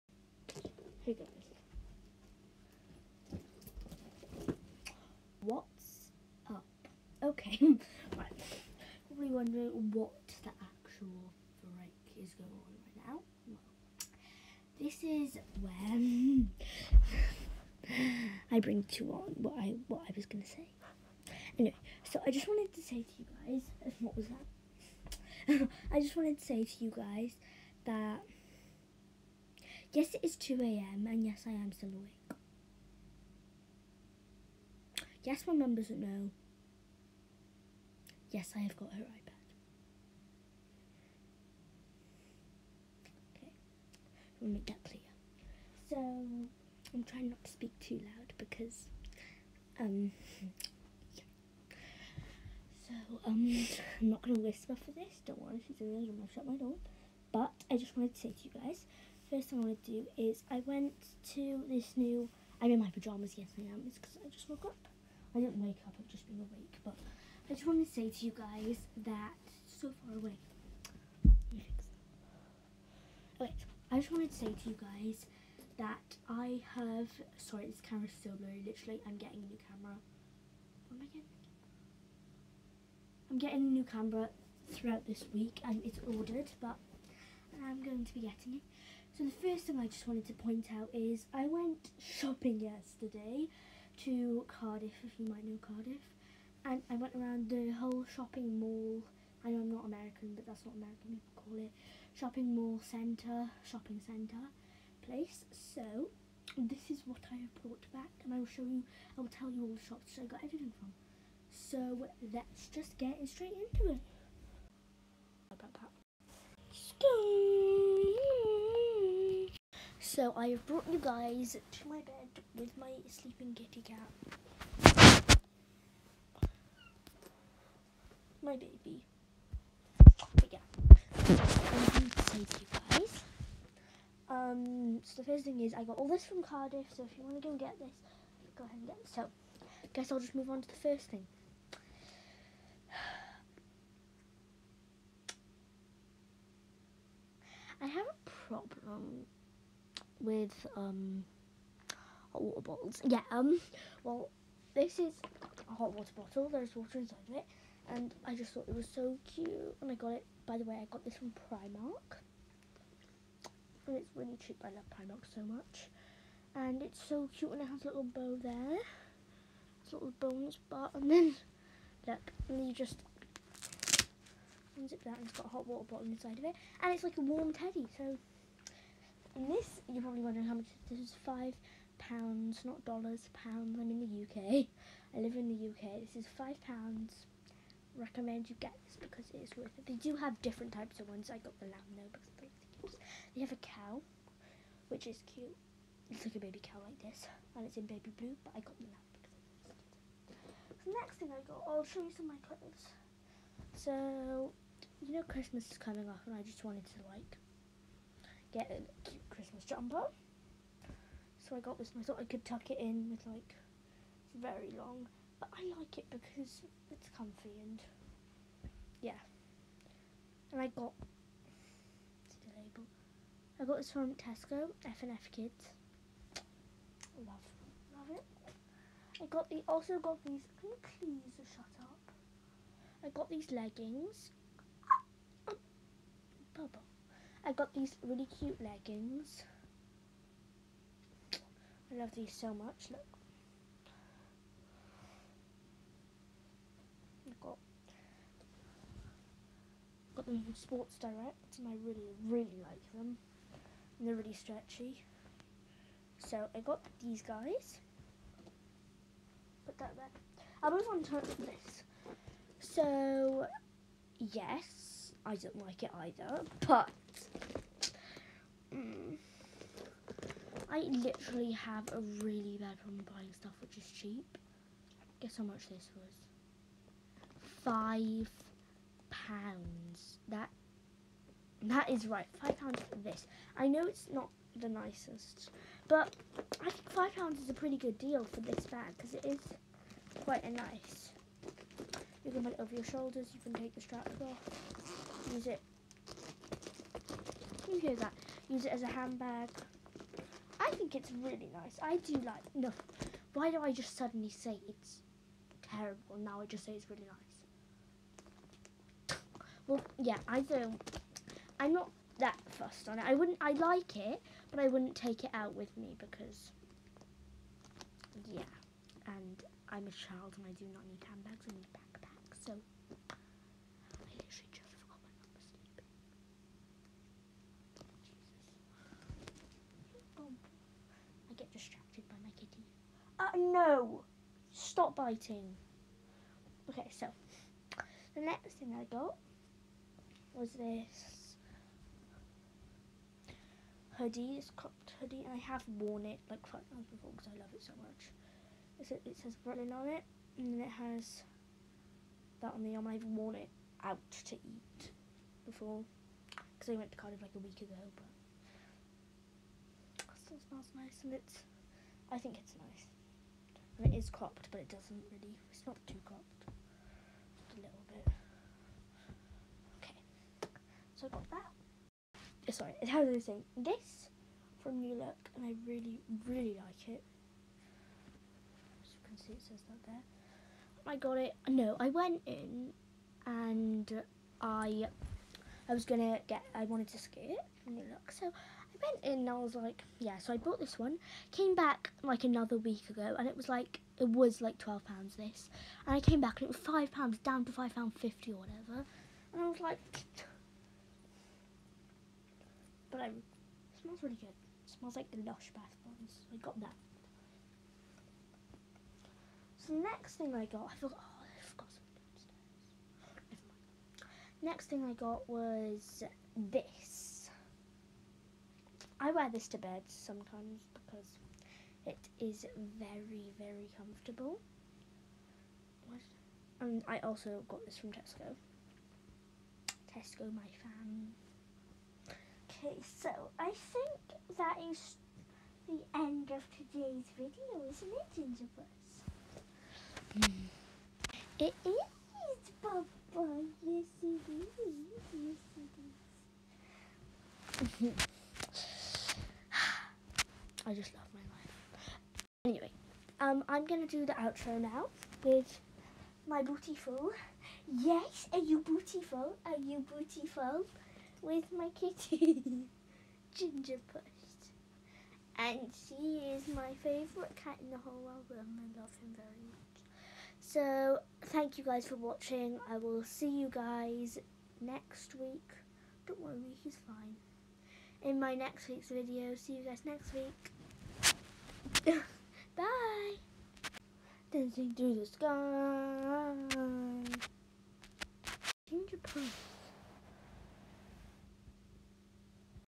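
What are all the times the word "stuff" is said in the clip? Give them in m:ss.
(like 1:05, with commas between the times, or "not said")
4:33.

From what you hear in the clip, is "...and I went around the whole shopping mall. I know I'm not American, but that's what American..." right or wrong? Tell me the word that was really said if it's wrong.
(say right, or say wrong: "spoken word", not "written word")
right.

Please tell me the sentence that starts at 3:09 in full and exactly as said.
They do have different types of ones.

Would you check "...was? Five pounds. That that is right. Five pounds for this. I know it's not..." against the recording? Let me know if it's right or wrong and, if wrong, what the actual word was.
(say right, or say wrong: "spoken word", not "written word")
right.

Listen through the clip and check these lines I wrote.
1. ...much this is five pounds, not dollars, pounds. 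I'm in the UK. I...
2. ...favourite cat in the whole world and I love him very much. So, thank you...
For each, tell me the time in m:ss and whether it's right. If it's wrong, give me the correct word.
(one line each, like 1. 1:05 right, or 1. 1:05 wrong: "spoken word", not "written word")
1. 3:00 right
2. 7:46 right.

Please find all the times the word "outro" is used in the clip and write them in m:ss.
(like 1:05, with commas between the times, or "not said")
7:34.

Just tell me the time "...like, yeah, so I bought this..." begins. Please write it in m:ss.
6:29.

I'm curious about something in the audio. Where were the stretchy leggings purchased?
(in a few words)
Sports Direct.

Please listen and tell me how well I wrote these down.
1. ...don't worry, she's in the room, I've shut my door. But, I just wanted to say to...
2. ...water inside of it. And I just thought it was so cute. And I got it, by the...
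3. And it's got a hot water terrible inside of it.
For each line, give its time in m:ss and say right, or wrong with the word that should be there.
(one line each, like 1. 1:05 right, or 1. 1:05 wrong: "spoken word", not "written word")
1. 0:55 right
2. 2:36 right
3. 2:55 wrong: "bottle", not "terrible".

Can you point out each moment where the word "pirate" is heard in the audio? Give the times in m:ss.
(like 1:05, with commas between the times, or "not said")
not said.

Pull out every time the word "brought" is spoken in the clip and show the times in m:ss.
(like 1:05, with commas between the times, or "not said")
1:47, 2:00.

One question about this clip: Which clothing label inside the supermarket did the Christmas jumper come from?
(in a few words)
F and F Kids.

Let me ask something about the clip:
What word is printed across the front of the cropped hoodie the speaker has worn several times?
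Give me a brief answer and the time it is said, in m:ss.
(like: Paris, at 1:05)
Berlin, at 5:48.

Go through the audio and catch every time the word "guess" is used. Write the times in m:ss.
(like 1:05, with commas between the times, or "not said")
2:19, 4:35.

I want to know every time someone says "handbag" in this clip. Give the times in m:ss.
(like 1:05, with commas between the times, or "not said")
4:58, 5:21.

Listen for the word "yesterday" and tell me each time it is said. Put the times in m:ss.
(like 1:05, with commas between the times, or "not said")
1:32.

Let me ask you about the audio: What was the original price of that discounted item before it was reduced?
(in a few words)
£12.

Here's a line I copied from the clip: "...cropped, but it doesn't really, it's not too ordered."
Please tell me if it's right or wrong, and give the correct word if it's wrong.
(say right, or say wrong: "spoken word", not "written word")
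wrong: "cropped", not "ordered".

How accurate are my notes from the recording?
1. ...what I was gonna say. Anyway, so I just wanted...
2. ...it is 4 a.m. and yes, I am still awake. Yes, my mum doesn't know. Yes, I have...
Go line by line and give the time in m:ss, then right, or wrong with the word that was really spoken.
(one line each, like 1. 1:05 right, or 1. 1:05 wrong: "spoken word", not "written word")
1. 0:19 right
2. 0:30 wrong: "2", not "4".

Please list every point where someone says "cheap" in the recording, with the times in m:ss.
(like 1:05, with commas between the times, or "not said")
2:44, 4:33.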